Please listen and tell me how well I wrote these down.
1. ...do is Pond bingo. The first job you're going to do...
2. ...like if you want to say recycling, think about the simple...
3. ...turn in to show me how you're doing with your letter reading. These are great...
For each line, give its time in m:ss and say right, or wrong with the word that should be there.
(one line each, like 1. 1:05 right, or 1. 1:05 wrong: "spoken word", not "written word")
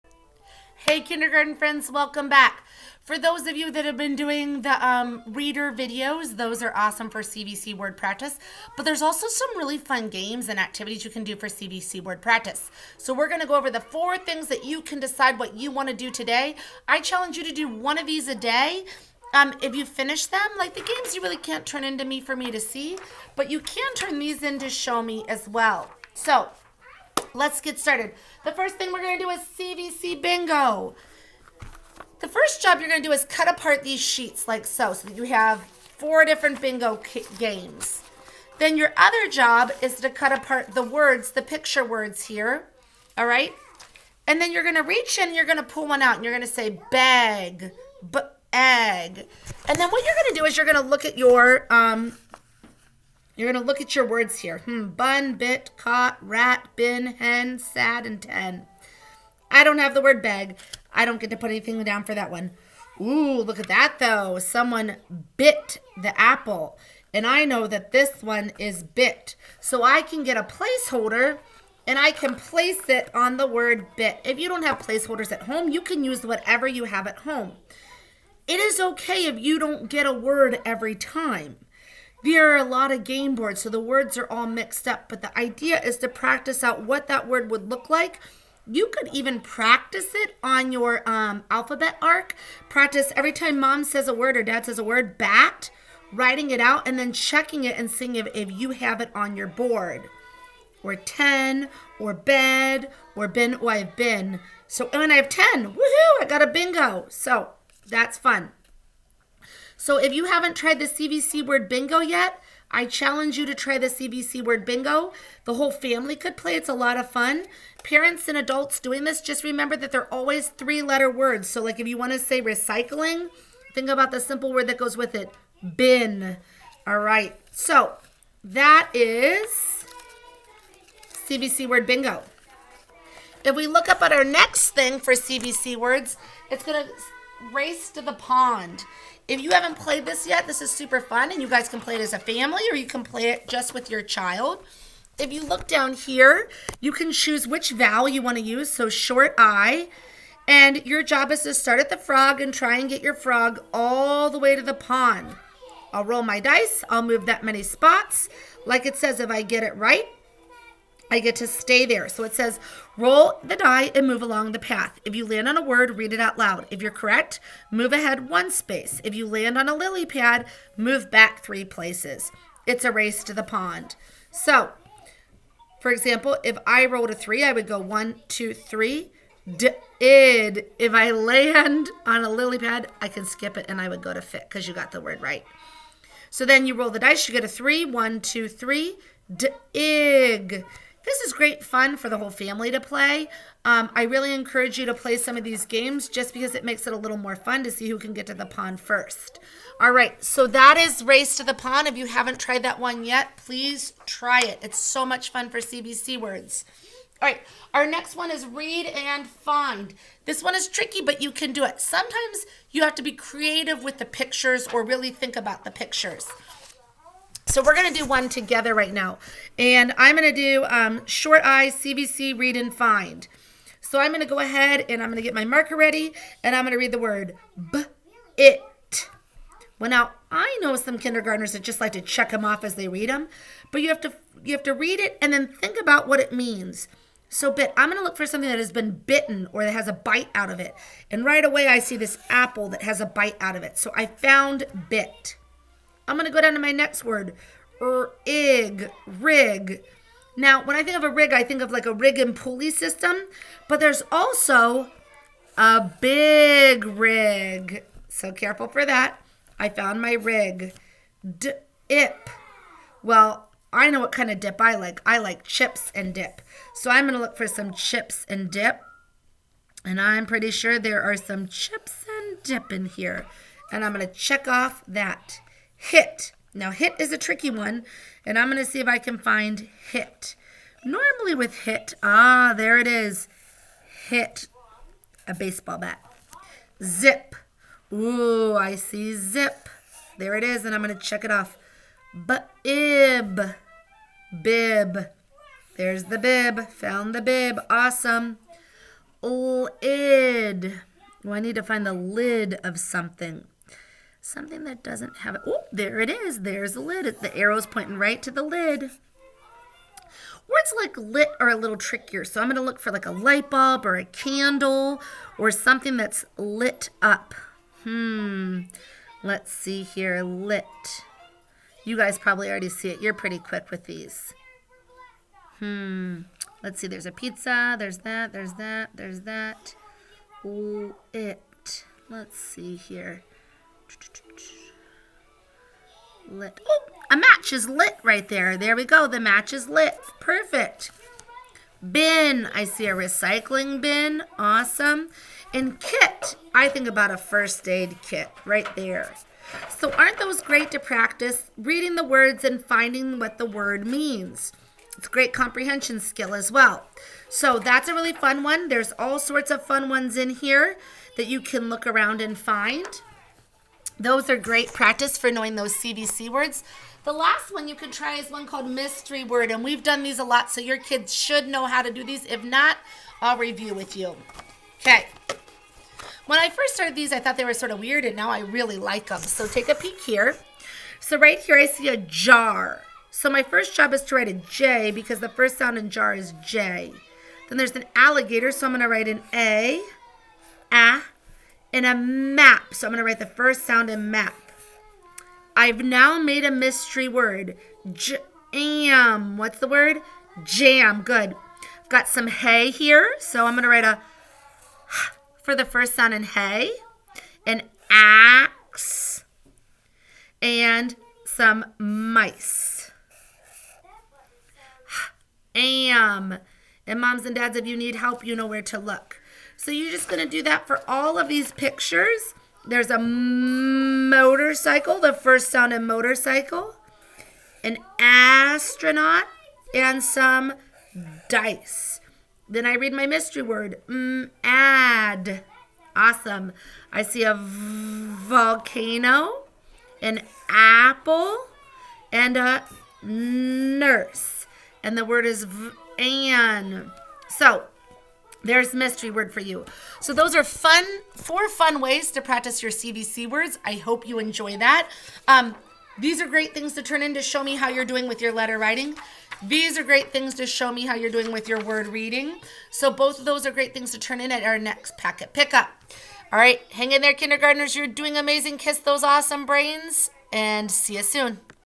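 1. 0:29 wrong: "CVC", not "Pond"
2. 2:01 right
3. 7:36 wrong: "writing", not "reading".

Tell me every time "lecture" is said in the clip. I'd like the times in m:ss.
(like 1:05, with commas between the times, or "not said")
not said.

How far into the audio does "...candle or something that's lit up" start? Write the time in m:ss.
5:14.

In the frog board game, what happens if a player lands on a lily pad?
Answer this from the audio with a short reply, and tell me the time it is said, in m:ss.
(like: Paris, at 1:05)
move back 3 places, at 2:50.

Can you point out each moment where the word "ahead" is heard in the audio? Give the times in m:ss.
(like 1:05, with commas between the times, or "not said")
2:47, 3:44.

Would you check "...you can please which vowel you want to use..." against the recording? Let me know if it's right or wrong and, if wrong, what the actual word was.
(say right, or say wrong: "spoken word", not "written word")
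wrong: "choose", not "please".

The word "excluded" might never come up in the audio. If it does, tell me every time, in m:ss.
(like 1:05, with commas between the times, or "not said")
not said.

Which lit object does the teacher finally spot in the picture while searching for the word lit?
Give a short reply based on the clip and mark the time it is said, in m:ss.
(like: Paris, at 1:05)
a match, at 5:37.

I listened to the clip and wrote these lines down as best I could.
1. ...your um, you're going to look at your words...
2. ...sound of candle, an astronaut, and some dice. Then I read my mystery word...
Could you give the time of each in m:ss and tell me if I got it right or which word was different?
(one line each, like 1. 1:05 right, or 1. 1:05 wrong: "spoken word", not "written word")
1. 0:51 right
2. 7:05 wrong: "motorcycle", not "candle".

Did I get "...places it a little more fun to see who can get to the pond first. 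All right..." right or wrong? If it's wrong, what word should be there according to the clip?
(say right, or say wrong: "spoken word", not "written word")
wrong: "makes", not "places".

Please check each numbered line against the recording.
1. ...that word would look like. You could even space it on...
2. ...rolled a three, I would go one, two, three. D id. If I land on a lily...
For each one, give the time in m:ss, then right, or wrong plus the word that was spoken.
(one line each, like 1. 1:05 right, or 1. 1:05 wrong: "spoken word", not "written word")
1. 1:27 wrong: "practice", not "space"
2. 2:56 right.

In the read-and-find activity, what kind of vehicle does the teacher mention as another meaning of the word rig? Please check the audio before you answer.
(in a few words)
big rig.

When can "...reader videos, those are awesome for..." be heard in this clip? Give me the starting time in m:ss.
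0:05.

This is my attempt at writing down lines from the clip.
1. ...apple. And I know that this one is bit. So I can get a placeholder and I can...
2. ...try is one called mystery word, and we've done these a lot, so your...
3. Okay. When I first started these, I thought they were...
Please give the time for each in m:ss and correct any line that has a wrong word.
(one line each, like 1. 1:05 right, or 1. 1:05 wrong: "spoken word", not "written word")
1. 1:06 right
2. 6:07 right
3. 6:14 right.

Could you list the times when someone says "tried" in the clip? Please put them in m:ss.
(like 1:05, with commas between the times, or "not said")
1:50, 3:22.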